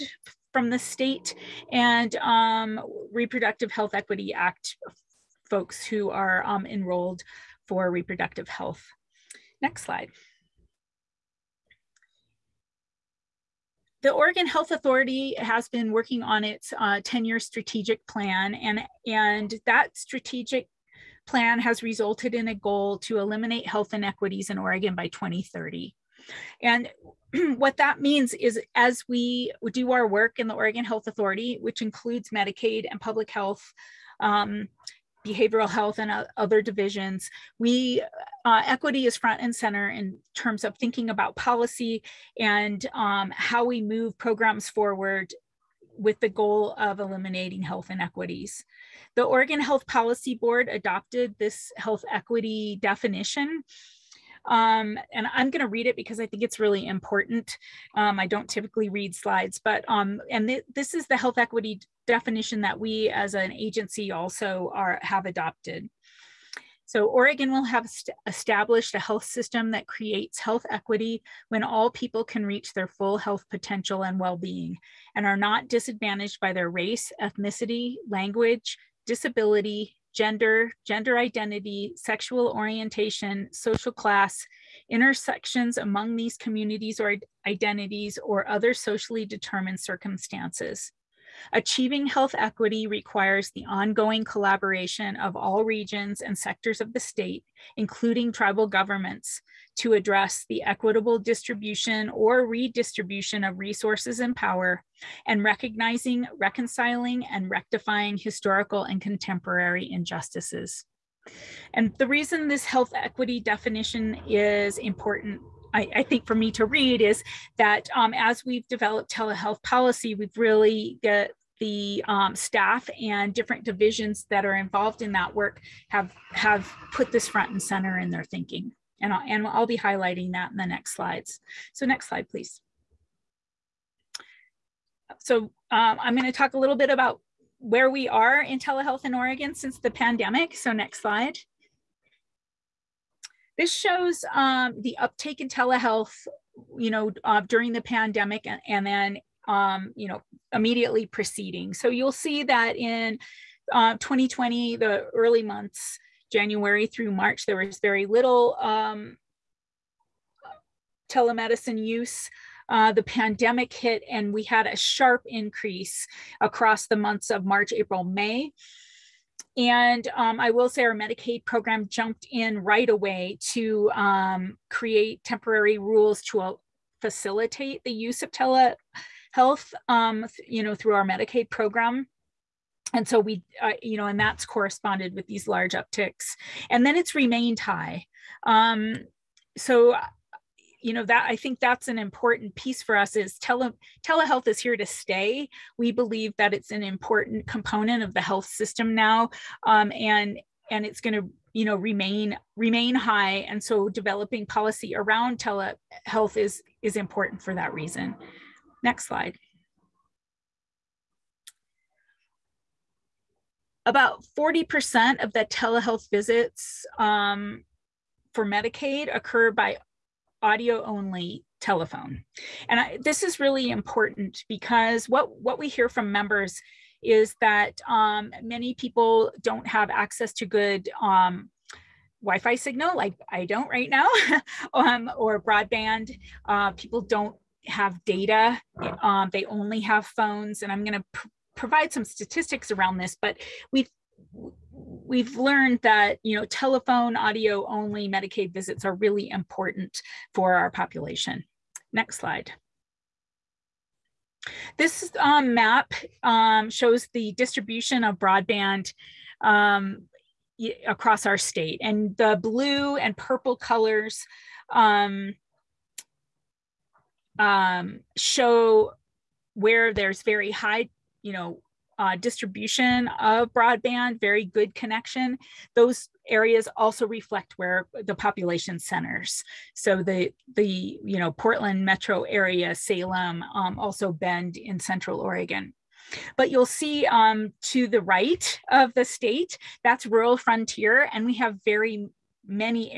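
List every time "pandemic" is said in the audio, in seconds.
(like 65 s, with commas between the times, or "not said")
139 s, 147 s, 163 s.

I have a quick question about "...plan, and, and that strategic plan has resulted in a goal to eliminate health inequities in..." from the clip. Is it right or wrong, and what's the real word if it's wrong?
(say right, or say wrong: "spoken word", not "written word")
right.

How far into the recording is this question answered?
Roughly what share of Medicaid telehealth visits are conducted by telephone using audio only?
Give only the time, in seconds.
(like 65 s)
214 s.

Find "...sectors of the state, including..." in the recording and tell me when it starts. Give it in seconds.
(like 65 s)
96 s.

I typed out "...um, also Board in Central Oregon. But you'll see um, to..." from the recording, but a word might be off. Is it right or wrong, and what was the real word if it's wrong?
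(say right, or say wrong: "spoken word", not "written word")
wrong: "Bend", not "Board".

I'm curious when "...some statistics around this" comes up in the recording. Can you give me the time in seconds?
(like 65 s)
241 s.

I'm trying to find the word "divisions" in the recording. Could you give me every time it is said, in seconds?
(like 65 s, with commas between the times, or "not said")
36 s, 123 s.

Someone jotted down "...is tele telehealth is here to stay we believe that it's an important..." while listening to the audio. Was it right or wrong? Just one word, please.
right.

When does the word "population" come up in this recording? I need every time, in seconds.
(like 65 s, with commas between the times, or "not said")
250 s, 278 s.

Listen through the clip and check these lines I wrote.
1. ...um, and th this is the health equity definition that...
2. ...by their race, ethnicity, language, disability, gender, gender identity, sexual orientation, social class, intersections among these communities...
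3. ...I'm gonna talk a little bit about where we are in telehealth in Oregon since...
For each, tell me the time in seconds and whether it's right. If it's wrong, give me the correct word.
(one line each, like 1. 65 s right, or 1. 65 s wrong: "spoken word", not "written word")
1. 59 s right
2. 76 s right
3. 136 s right.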